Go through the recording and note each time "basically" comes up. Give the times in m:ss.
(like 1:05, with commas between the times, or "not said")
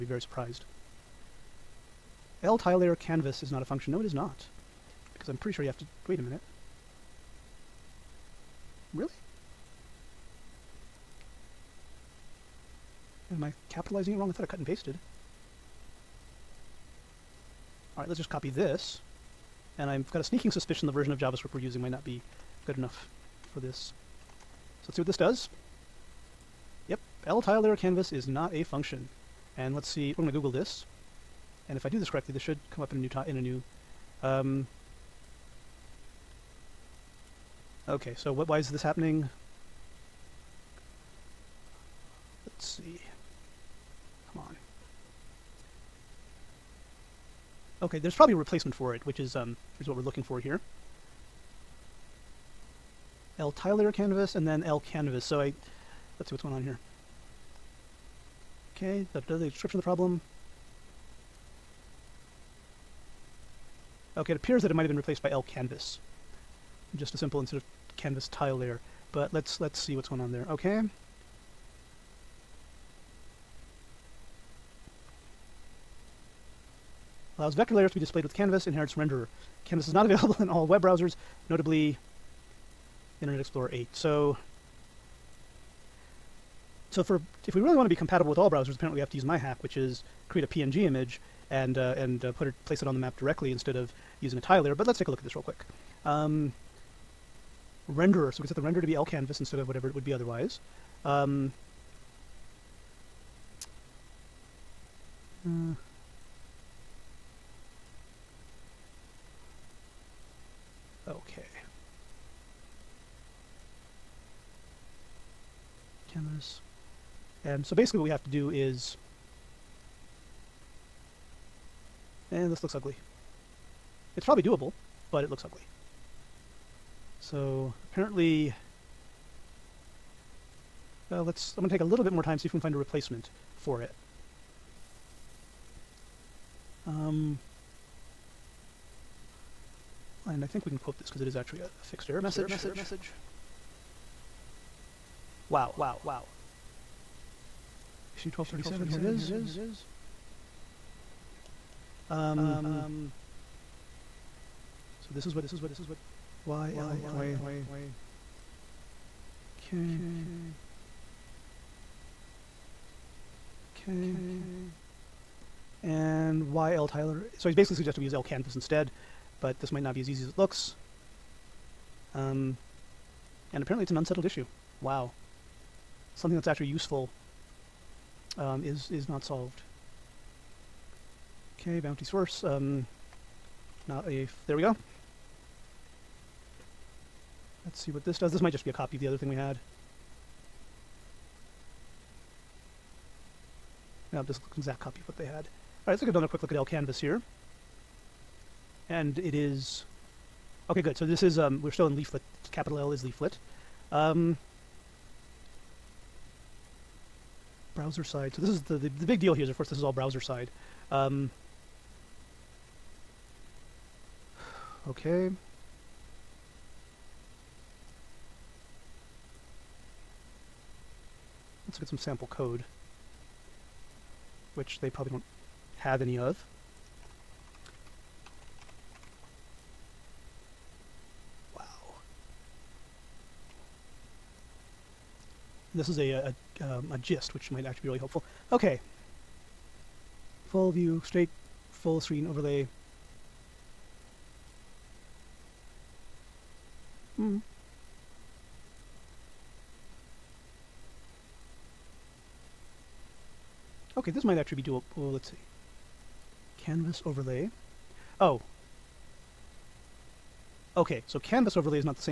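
1:57, 2:47.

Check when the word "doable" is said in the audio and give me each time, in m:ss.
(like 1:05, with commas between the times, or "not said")
2:04, 4:14.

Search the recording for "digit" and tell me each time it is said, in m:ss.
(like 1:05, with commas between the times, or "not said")
not said.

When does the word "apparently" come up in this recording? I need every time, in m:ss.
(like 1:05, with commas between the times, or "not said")
1:28, 2:07, 2:53.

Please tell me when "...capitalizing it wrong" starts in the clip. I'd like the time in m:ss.
0:13.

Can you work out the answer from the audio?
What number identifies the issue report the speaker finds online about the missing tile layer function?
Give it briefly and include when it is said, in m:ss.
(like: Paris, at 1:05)
1237, at 2:28.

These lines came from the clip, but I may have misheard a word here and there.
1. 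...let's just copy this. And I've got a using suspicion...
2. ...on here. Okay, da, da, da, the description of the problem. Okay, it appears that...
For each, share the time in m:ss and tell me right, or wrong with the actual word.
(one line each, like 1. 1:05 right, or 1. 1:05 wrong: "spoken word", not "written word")
1. 0:18 wrong: "sneaking", not "using"
2. 0:56 right.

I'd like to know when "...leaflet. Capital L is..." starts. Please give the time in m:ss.
3:21.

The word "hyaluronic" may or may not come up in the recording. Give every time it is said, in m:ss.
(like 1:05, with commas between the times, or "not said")
not said.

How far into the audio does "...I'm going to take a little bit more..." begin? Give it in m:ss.
2:11.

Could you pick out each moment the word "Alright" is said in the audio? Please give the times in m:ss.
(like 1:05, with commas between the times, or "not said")
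0:17, 3:15.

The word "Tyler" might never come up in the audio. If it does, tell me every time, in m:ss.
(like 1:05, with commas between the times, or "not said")
2:46.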